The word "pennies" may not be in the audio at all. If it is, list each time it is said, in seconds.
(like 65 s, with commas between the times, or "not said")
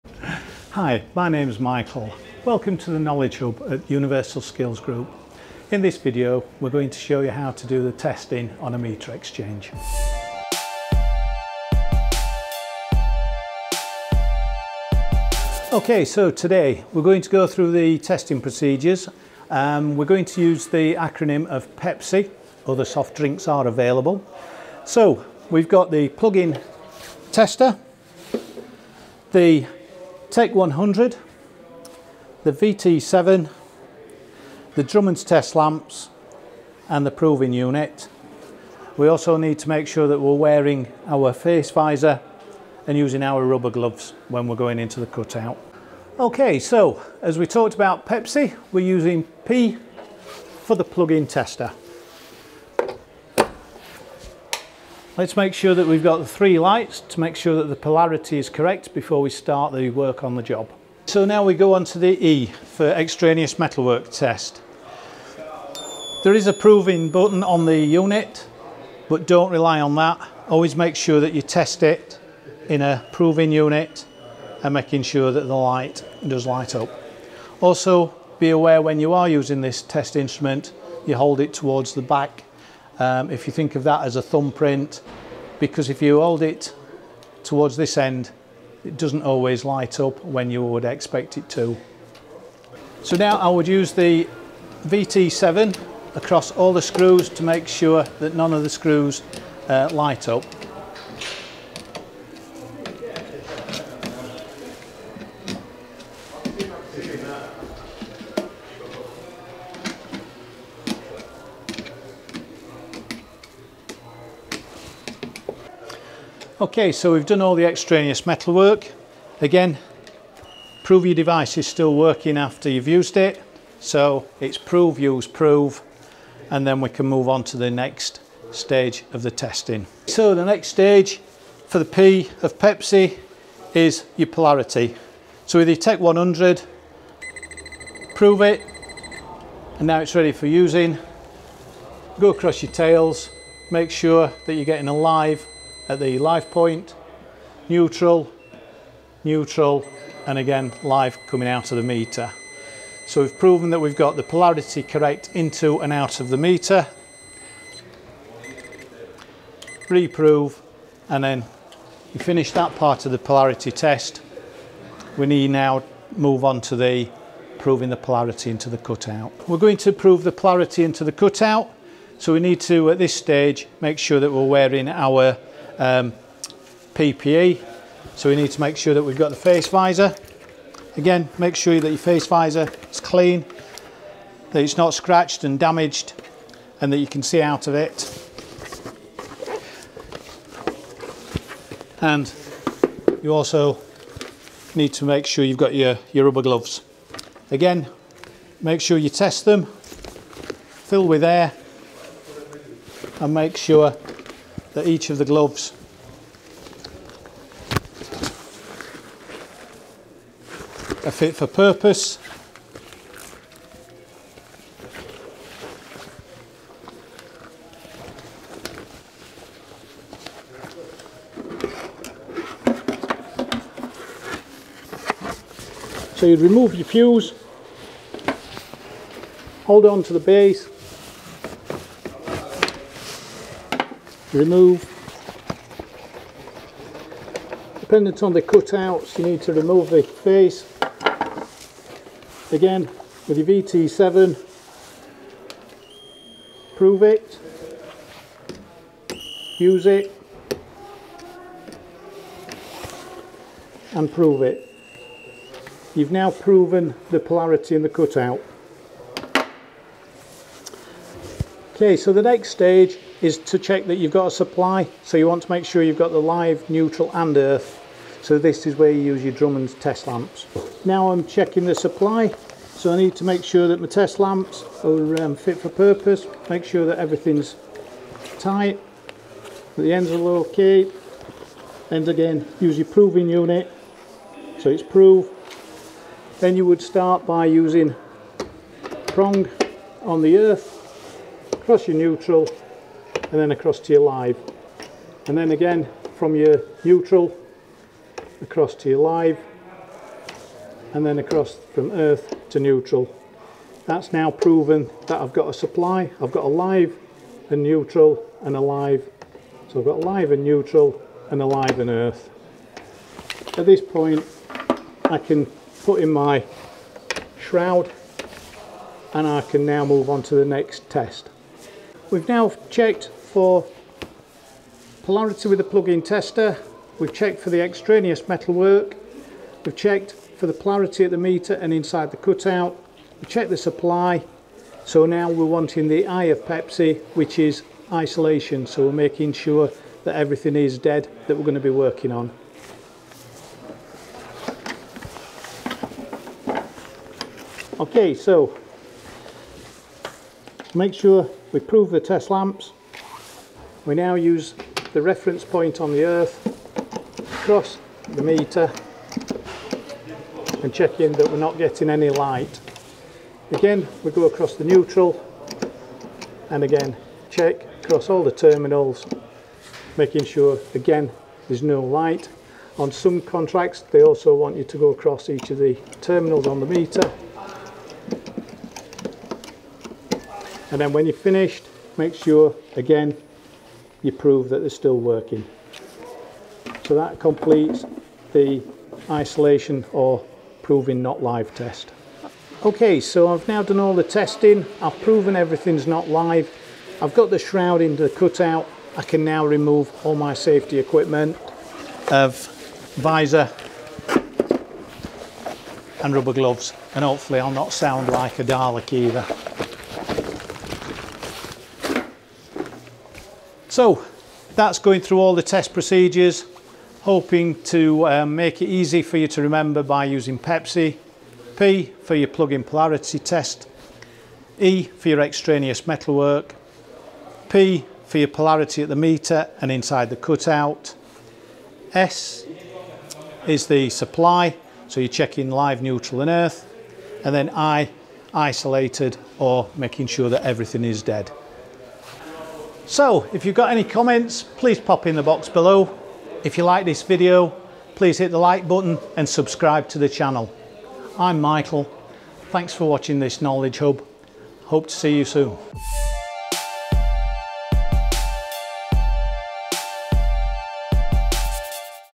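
not said.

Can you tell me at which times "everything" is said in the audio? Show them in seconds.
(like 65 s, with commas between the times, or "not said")
276 s, 340 s, 395 s, 440 s.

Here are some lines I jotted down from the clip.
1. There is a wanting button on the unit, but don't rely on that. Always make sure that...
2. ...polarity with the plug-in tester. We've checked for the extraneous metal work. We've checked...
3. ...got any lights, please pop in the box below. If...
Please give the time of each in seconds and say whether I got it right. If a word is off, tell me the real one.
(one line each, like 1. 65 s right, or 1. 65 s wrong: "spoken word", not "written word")
1. 66 s wrong: "proving", not "wanting"
2. 325 s right
3. 443 s wrong: "comments", not "lights".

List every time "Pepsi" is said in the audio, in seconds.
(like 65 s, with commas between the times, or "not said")
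21 s, 48 s, 132 s, 336 s, 420 s.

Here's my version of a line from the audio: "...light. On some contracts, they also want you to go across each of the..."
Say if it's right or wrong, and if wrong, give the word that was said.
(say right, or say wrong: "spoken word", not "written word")
right.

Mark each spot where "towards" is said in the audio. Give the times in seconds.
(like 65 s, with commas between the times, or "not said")
81 s, 87 s.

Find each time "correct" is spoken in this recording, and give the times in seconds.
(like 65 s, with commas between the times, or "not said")
58 s, 154 s.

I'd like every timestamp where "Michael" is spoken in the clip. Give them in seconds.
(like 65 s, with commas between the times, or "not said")
1 s, 451 s.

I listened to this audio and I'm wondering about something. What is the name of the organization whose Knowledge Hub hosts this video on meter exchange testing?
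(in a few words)
Universal Skills Group.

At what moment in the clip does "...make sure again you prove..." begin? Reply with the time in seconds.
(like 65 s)
381 s.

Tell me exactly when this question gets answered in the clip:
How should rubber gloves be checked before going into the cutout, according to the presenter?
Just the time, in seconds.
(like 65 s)
199 s.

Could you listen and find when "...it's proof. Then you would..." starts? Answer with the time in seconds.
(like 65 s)
284 s.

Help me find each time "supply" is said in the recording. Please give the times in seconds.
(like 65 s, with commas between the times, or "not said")
264 s, 271 s, 305 s, 333 s, 433 s.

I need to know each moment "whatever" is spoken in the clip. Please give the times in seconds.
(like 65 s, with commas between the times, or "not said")
not said.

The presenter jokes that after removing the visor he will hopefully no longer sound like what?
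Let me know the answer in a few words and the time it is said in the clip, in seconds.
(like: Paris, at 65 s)
A Dalek, at 408 s.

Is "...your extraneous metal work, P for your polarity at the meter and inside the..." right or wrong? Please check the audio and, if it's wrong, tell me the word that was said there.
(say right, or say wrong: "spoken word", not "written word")
right.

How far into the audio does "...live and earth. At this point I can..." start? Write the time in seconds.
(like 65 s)
311 s.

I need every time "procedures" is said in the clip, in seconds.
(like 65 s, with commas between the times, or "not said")
18 s, 415 s.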